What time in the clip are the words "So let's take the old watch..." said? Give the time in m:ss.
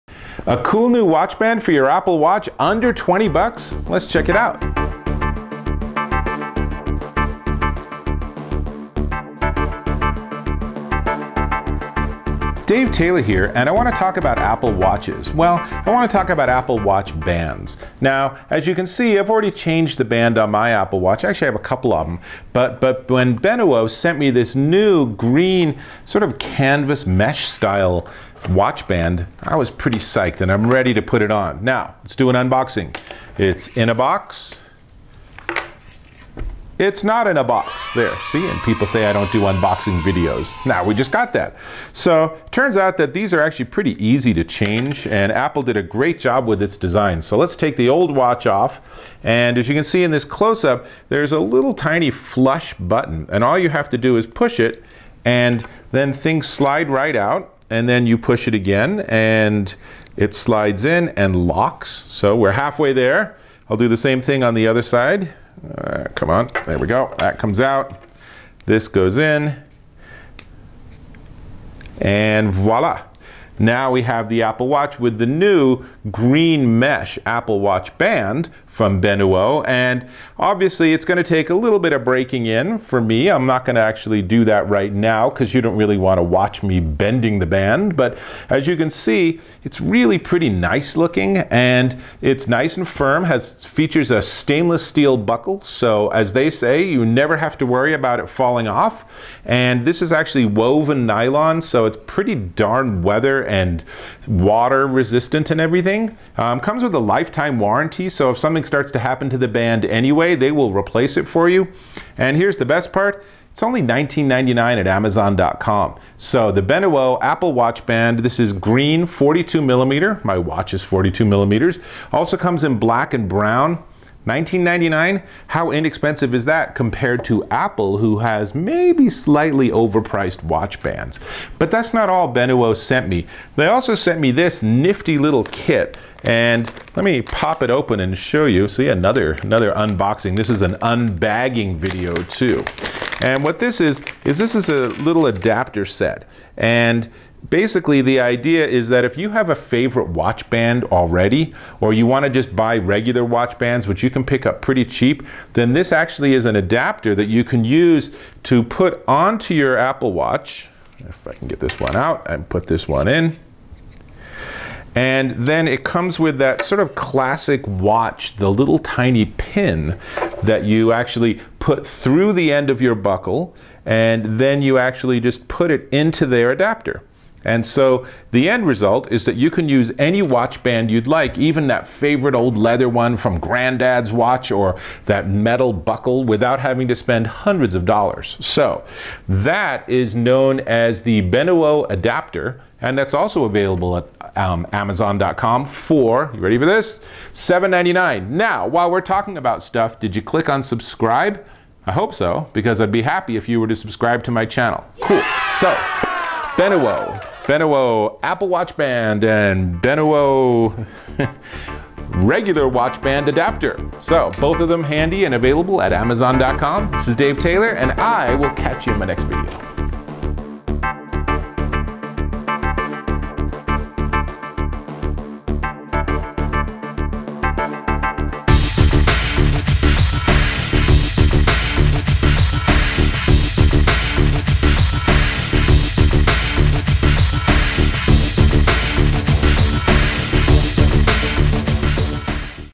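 0:47.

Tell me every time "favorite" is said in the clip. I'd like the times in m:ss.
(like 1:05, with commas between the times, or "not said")
2:29, 3:01.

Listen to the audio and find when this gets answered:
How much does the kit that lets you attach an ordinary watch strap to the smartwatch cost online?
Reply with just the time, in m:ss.
3:17.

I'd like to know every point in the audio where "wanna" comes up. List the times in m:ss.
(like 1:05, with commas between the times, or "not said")
1:25, 2:32.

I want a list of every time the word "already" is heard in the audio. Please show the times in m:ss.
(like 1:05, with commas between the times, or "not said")
0:19, 2:30.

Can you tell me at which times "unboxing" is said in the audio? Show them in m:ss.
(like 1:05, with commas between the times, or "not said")
0:32, 0:39, 2:19.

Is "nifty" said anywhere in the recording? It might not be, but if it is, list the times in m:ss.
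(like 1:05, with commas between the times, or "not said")
2:14.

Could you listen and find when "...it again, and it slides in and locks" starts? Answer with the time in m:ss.
0:58.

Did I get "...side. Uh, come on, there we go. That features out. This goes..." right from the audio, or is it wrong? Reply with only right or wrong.
wrong.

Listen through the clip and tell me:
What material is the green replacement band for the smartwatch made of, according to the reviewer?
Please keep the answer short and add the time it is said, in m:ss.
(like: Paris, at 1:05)
Woven nylon, at 1:40.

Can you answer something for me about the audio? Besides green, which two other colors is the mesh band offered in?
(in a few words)
Black and brown.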